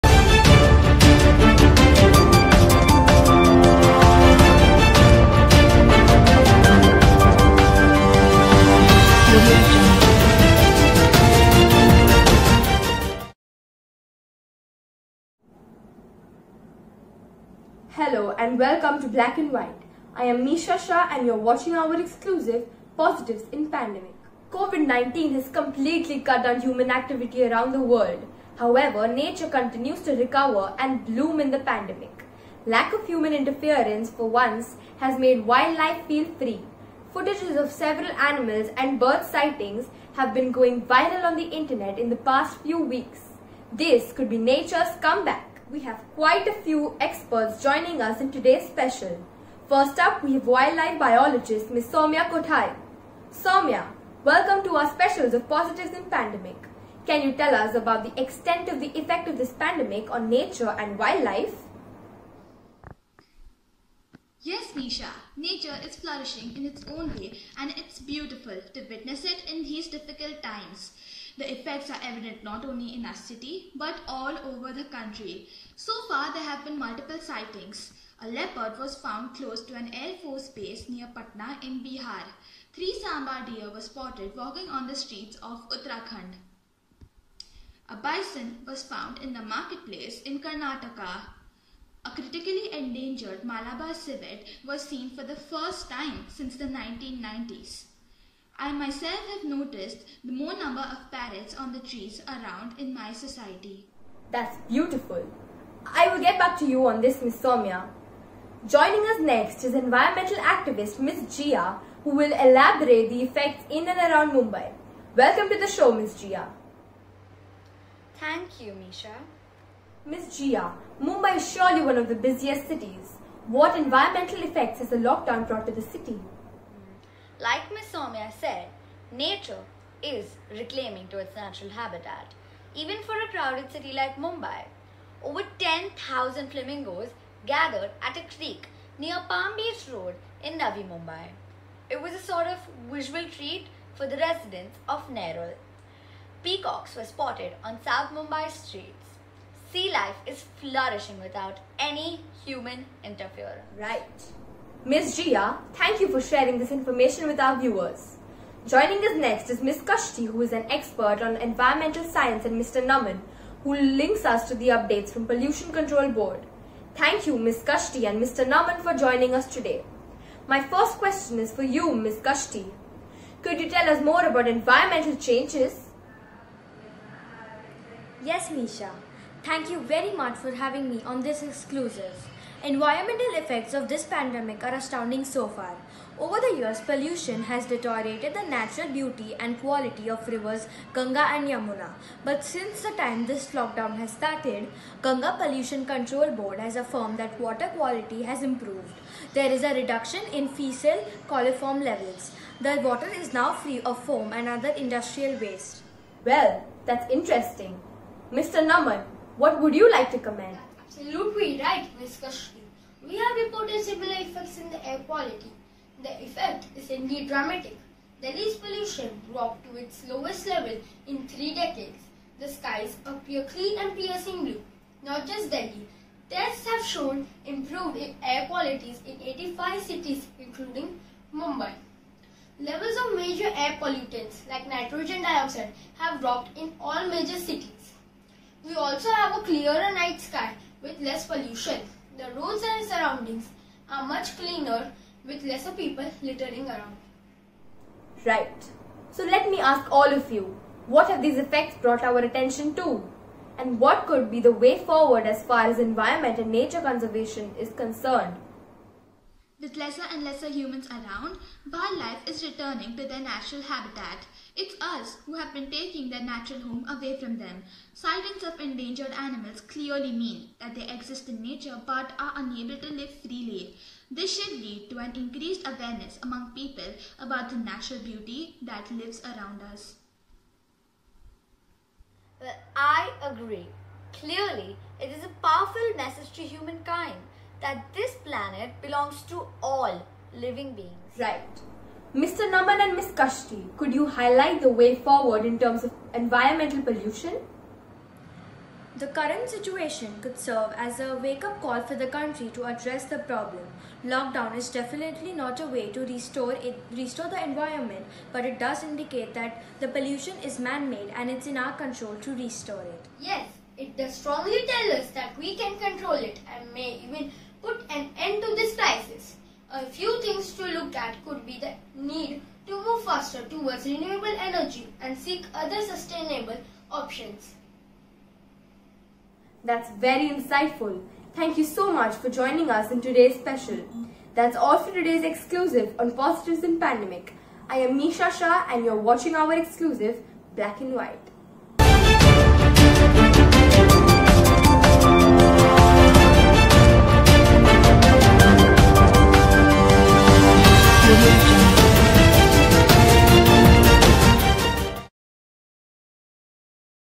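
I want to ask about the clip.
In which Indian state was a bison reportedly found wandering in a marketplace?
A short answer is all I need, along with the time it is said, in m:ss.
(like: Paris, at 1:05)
Karnataka, at 1:30.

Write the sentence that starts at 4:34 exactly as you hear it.
This should lead to an increased awareness among people about the natural beauty that lives around us.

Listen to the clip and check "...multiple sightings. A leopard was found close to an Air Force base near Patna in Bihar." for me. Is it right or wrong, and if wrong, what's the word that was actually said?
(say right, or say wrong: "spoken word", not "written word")
right.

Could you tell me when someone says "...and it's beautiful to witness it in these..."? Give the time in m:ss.
1:07.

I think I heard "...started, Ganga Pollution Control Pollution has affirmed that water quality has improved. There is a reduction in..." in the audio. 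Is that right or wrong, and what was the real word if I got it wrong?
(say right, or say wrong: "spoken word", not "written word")
wrong: "Board", not "Pollution".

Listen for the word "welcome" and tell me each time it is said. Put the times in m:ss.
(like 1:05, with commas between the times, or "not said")
0:18, 0:54, 1:55.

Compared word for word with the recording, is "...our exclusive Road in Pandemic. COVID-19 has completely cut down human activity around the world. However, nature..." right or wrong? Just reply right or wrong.
wrong.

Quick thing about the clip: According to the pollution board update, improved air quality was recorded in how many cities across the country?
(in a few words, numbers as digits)
85.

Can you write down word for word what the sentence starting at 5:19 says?
A few things to look at could be the need to move faster towards renewable energy and seek other sustainable options.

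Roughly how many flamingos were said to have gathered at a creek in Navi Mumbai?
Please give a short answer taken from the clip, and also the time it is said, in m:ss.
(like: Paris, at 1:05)
10,000, at 2:15.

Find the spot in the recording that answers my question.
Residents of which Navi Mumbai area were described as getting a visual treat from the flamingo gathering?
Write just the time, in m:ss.
2:25.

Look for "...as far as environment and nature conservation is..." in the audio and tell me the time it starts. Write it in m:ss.
4:15.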